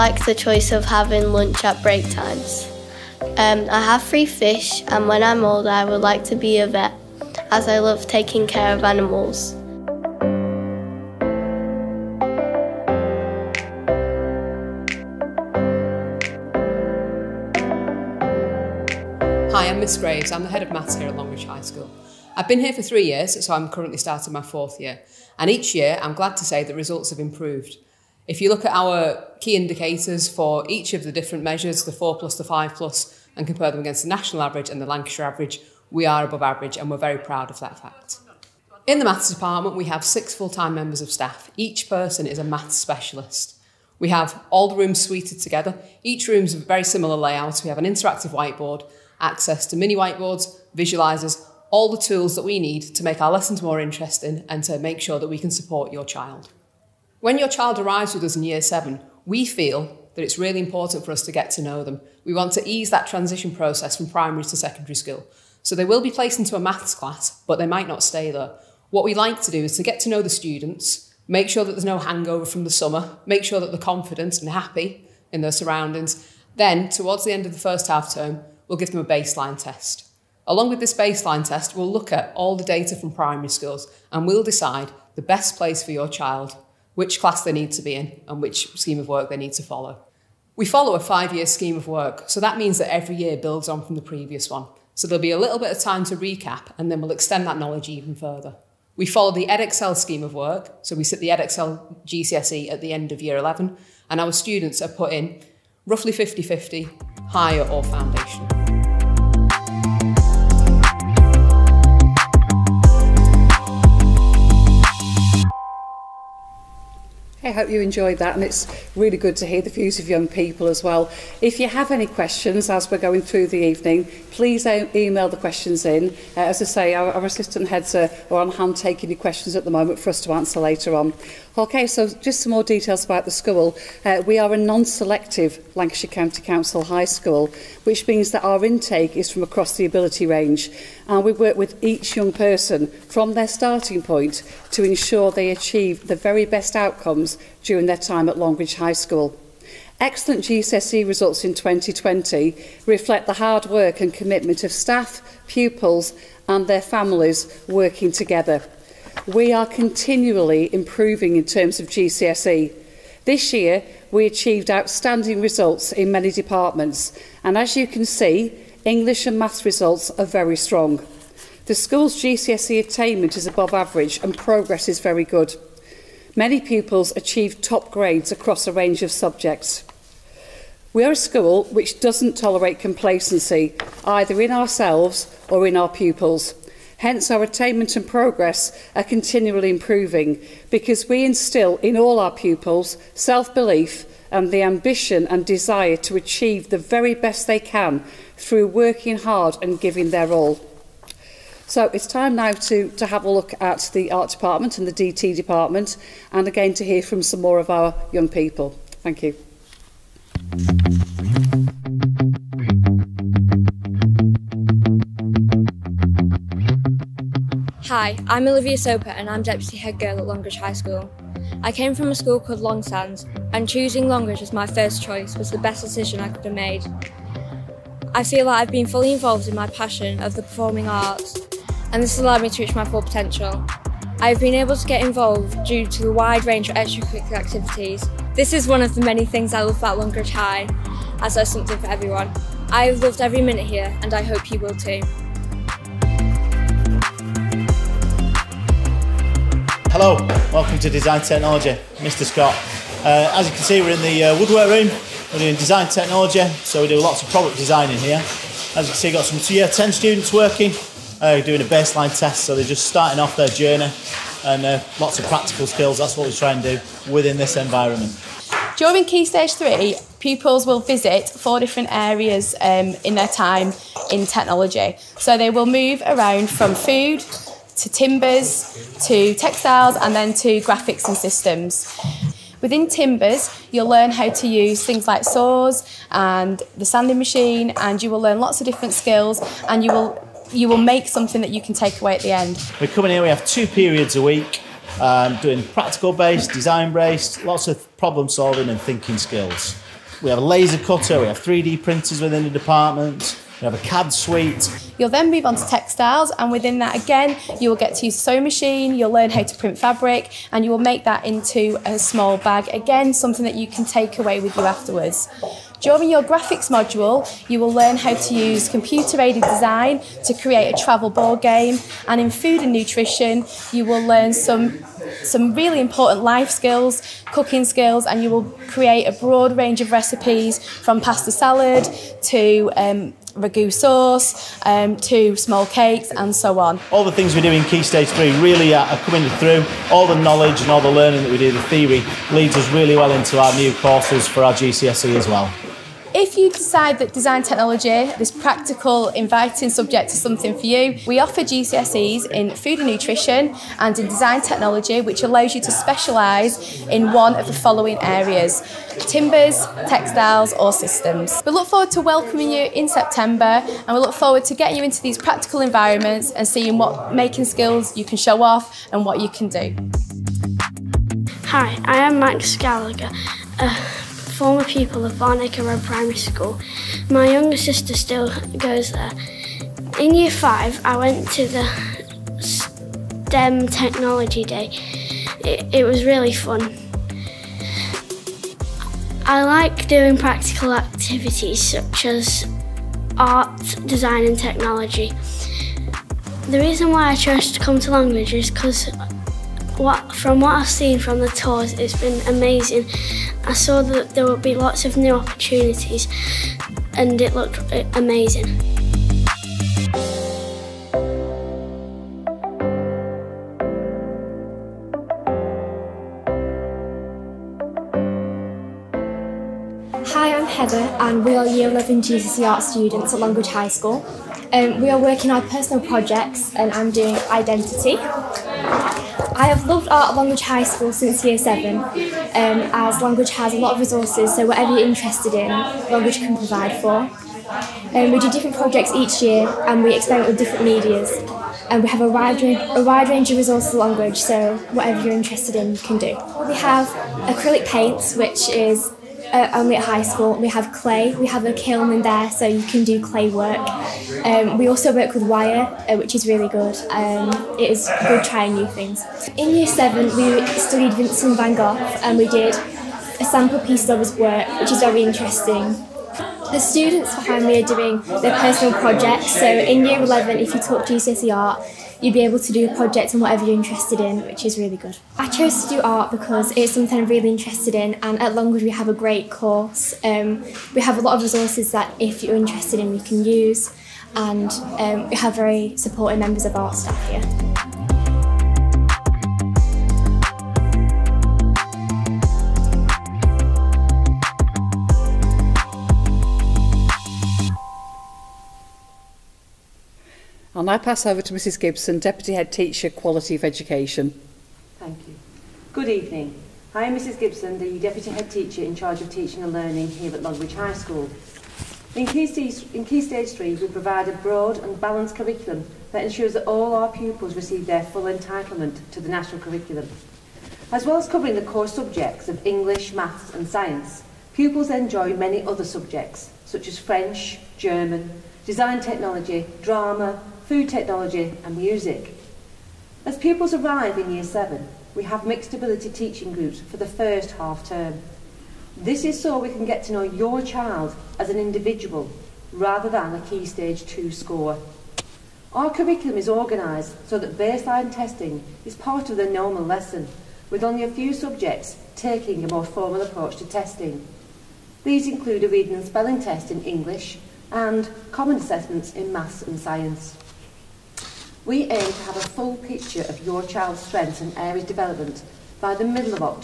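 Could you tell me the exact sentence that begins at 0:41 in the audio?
Each person is a maths specialist.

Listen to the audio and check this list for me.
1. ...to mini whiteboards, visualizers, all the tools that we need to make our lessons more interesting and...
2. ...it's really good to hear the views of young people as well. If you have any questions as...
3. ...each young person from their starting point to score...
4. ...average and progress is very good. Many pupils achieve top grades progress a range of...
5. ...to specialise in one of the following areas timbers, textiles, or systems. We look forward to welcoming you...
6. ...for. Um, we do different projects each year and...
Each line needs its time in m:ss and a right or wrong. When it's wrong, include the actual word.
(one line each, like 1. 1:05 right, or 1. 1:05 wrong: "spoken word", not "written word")
1. 0:49 right
2. 1:58 right
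3. 2:21 wrong: "ensure", not "score"
4. 2:53 wrong: "across", not "progress"
5. 5:55 right
6. 7:16 right.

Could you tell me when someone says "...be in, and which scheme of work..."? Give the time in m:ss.
1:27.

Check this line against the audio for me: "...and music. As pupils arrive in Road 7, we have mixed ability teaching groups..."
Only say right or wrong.
wrong.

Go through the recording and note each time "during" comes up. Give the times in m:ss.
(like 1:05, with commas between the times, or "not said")
2:27, 4:28, 5:15.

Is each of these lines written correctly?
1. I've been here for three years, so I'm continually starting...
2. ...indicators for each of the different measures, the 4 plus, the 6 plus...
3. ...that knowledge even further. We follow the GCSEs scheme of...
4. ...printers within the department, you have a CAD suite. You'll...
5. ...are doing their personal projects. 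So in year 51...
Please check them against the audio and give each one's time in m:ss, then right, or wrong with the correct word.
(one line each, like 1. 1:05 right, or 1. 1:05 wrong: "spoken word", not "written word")
1. 0:22 wrong: "currently", not "continually"
2. 0:29 wrong: "5", not "6"
3. 1:37 wrong: "Edexcel", not "GCSEs"
4. 5:01 right
5. 7:47 wrong: "11", not "51".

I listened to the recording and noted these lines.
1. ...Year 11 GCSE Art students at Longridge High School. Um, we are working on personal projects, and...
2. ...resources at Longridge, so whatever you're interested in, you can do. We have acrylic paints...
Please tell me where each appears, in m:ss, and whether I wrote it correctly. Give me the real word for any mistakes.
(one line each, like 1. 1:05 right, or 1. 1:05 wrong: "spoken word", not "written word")
1. 7:01 right
2. 7:23 right.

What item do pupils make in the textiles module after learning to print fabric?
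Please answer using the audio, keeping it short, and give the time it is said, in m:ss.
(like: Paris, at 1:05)
small bag, at 5:11.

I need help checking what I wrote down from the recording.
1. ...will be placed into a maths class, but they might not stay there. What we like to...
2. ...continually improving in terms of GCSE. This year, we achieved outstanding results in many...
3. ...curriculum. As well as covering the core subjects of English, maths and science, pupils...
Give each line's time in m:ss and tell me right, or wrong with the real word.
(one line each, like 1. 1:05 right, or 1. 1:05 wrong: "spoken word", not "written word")
1. 1:05 right
2. 2:39 right
3. 8:39 right.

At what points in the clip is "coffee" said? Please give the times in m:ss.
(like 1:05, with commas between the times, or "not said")
not said.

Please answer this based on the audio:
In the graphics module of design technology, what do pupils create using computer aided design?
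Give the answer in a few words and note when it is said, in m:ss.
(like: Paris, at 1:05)
travel board game, at 5:20.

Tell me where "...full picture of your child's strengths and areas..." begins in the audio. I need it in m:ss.
9:22.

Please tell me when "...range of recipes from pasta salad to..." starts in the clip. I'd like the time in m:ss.
5:29.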